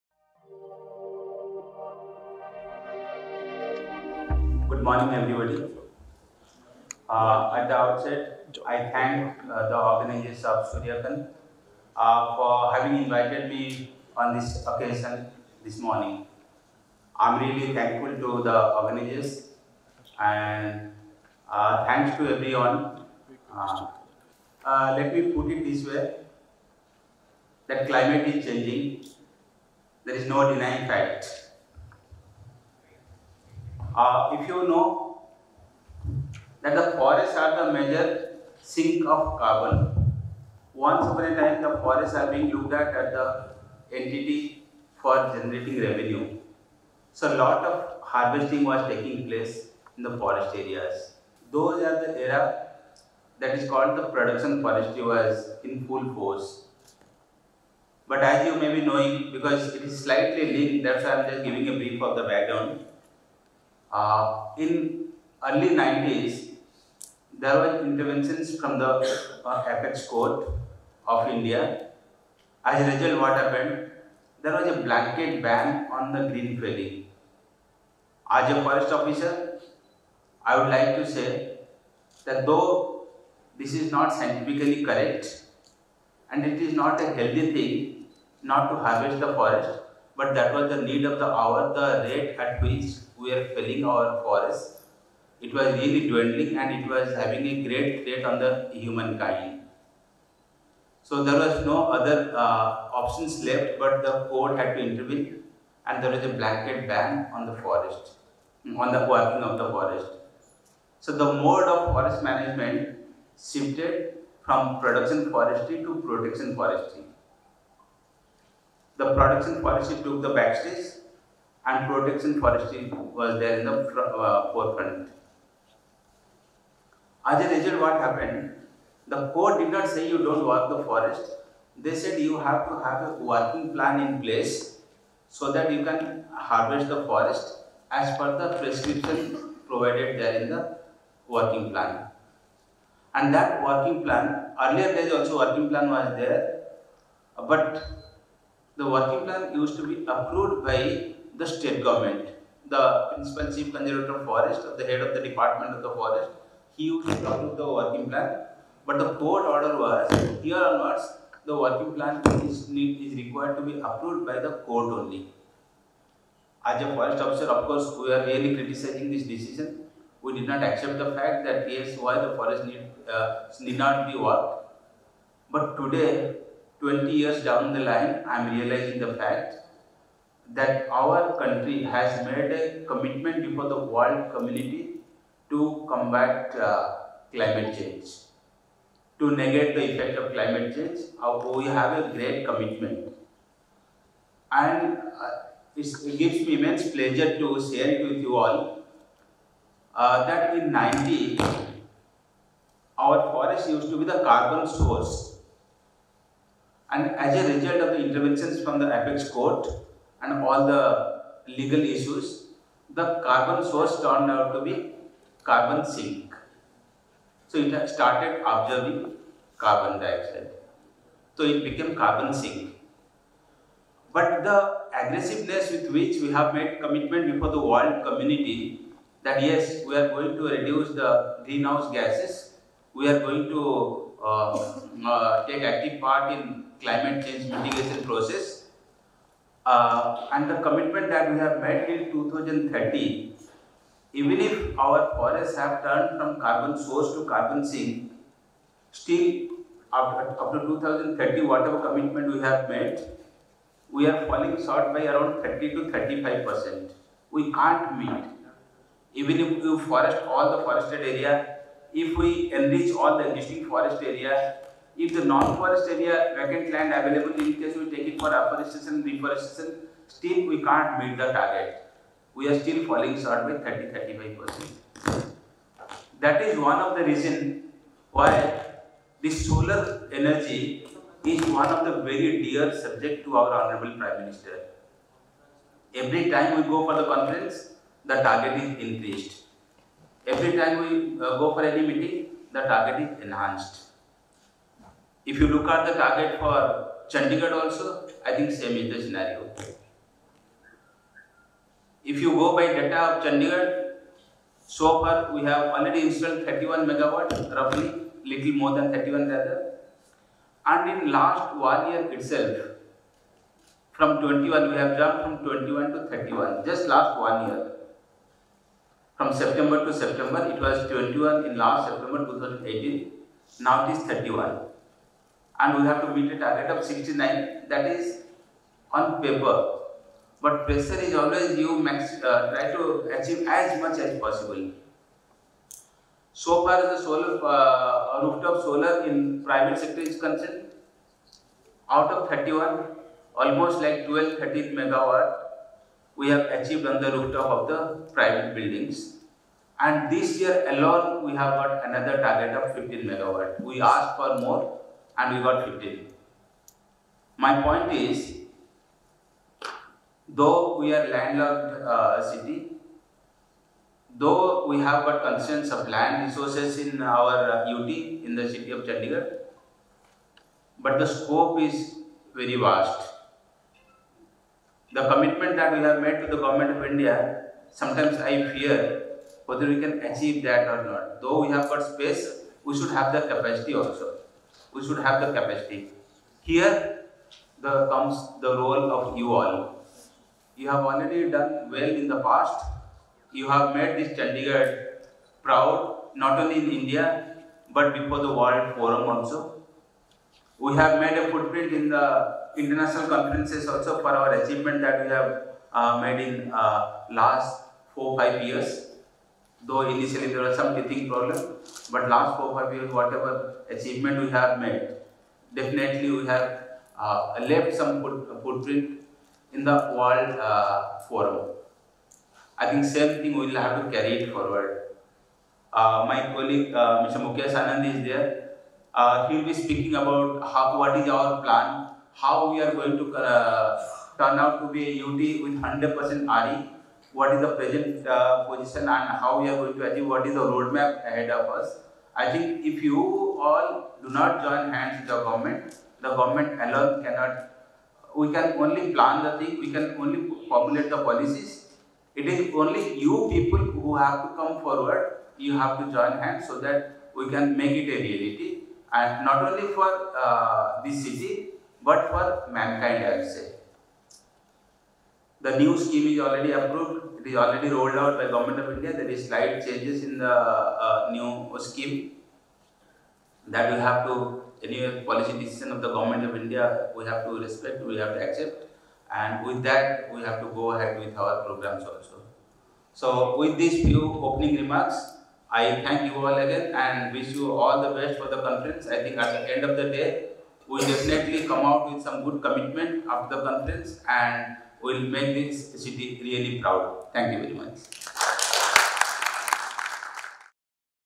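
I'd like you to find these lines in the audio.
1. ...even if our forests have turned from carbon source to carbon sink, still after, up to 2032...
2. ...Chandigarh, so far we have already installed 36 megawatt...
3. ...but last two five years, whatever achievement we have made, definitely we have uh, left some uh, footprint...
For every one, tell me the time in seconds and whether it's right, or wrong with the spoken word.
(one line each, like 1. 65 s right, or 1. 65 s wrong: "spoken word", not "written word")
1. 244 s wrong: "2030", not "2032"
2. 303 s wrong: "31", not "36"
3. 411 s wrong: "four", not "two".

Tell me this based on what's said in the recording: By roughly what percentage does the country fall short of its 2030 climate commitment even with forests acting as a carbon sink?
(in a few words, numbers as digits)
30 to 35 percent.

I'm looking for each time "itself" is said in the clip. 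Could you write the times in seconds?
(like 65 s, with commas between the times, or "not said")
312 s.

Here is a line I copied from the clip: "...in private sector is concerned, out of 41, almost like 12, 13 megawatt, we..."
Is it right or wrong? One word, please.
wrong.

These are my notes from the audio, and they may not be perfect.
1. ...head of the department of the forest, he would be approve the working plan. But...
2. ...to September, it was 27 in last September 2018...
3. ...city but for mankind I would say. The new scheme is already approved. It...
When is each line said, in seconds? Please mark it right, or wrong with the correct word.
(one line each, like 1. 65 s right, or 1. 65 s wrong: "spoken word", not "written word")
1. 154 s right
2. 319 s wrong: "21", not "27"
3. 461 s right.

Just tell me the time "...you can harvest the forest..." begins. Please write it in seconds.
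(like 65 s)
135 s.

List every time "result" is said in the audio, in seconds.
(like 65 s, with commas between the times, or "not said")
72 s, 127 s, 207 s.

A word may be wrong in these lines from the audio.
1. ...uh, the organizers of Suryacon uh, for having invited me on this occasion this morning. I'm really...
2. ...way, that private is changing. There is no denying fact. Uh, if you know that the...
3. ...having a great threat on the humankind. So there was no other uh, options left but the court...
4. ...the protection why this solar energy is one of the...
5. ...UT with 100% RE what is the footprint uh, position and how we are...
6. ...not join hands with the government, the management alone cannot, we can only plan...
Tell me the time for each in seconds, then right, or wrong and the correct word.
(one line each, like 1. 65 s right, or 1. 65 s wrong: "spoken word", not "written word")
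1. 9 s right
2. 25 s wrong: "climate", not "private"
3. 97 s right
4. 276 s wrong: "reason", not "protection"
5. 435 s wrong: "present", not "footprint"
6. 444 s wrong: "government", not "management".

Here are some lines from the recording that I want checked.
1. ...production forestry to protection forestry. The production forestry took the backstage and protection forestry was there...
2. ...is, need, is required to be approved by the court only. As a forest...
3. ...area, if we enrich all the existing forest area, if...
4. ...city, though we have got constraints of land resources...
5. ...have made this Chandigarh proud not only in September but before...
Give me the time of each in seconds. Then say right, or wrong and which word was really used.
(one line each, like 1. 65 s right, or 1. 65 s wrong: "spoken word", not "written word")
1. 114 s right
2. 162 s right
3. 261 s right
4. 362 s right
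5. 393 s wrong: "India", not "September".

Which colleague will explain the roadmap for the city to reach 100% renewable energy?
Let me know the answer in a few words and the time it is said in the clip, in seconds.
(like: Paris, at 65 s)
Mukesh Anand, at 427 s.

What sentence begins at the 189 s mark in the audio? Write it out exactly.
To negate the effect of climate change, uh, we have a great commitment.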